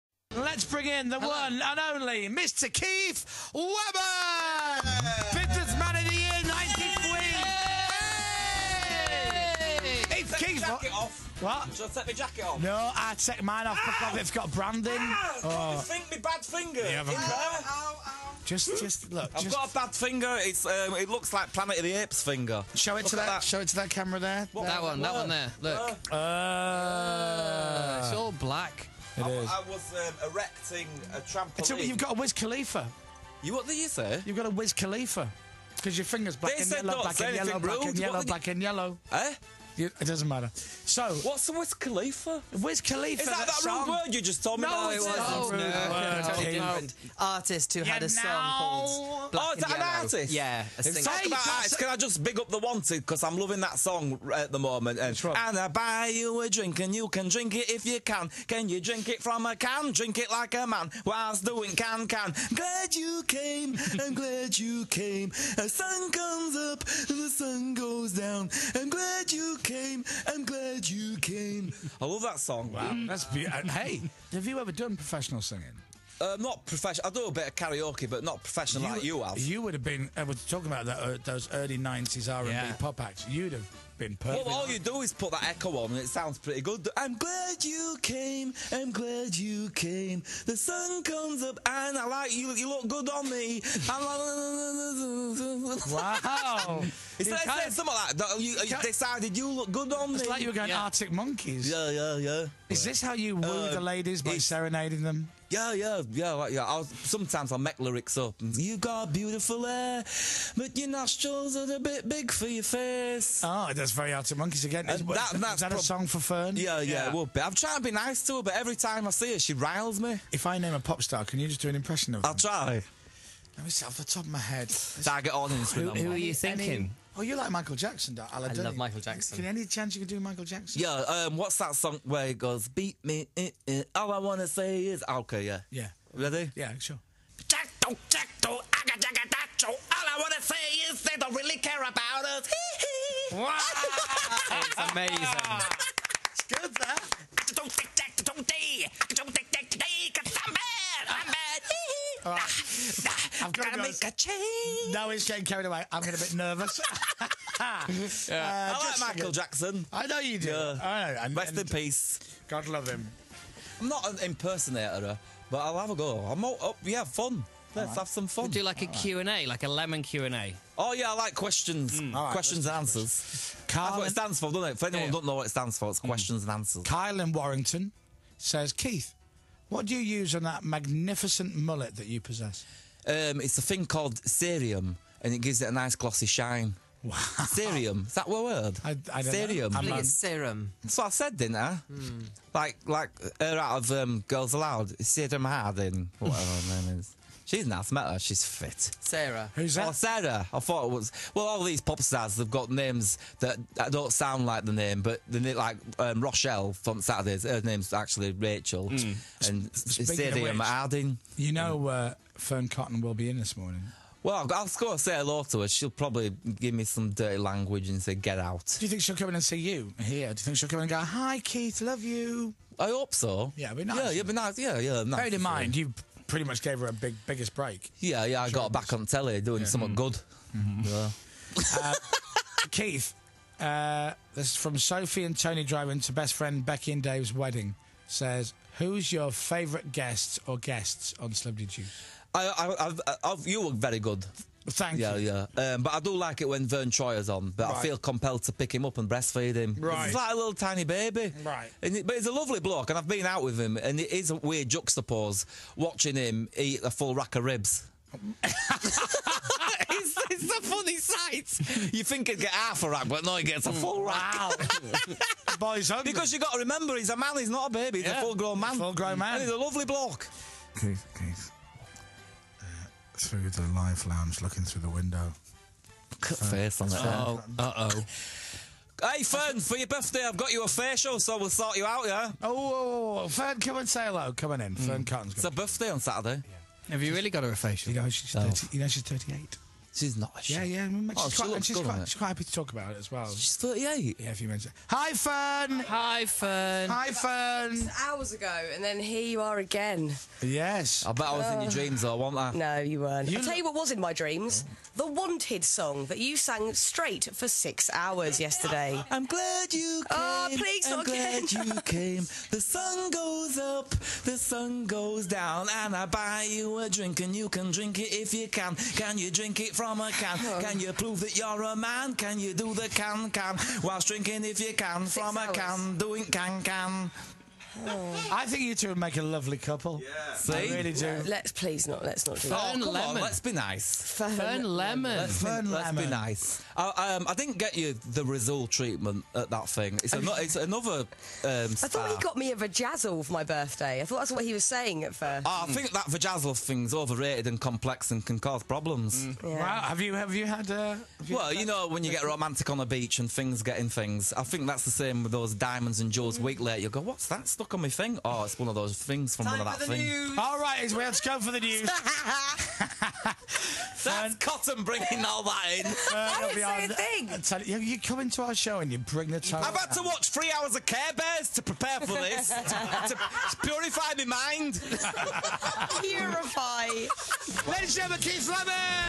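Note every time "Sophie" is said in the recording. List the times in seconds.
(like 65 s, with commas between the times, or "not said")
234 s.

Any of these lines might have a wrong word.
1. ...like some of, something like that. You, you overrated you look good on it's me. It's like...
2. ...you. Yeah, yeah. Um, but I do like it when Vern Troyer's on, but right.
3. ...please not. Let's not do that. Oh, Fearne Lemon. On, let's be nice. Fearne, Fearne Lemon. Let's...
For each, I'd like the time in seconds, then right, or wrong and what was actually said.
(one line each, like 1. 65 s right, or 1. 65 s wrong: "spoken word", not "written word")
1. 97 s wrong: "decided", not "overrated"
2. 245 s right
3. 331 s right.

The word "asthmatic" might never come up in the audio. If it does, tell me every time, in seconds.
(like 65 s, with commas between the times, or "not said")
197 s.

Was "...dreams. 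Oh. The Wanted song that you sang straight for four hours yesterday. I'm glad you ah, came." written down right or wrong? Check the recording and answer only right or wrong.
wrong.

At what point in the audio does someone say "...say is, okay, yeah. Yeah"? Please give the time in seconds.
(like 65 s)
134 s.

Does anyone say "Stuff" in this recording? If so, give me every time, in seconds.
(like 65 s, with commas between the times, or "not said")
357 s.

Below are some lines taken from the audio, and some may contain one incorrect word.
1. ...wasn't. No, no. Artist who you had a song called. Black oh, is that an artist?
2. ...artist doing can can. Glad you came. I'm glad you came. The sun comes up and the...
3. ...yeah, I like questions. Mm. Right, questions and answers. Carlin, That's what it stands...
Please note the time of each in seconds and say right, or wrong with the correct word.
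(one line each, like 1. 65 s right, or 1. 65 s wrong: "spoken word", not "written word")
1. 45 s right
2. 61 s wrong: "whilst", not "artist"
3. 170 s right.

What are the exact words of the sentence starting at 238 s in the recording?
Says, who's your favourite guest or guests on Celebrity Juice?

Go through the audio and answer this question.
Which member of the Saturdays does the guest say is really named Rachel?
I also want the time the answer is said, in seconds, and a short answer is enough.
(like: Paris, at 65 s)
Rochelle, at 206 s.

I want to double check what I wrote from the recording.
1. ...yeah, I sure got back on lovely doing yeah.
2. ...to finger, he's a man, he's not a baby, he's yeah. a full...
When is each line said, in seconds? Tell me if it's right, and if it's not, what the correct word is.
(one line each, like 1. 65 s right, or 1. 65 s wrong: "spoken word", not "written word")
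1. 228 s wrong: "telly", not "lovely"
2. 266 s wrong: "remember", not "finger".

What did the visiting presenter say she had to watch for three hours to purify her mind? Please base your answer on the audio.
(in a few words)
Care Bears.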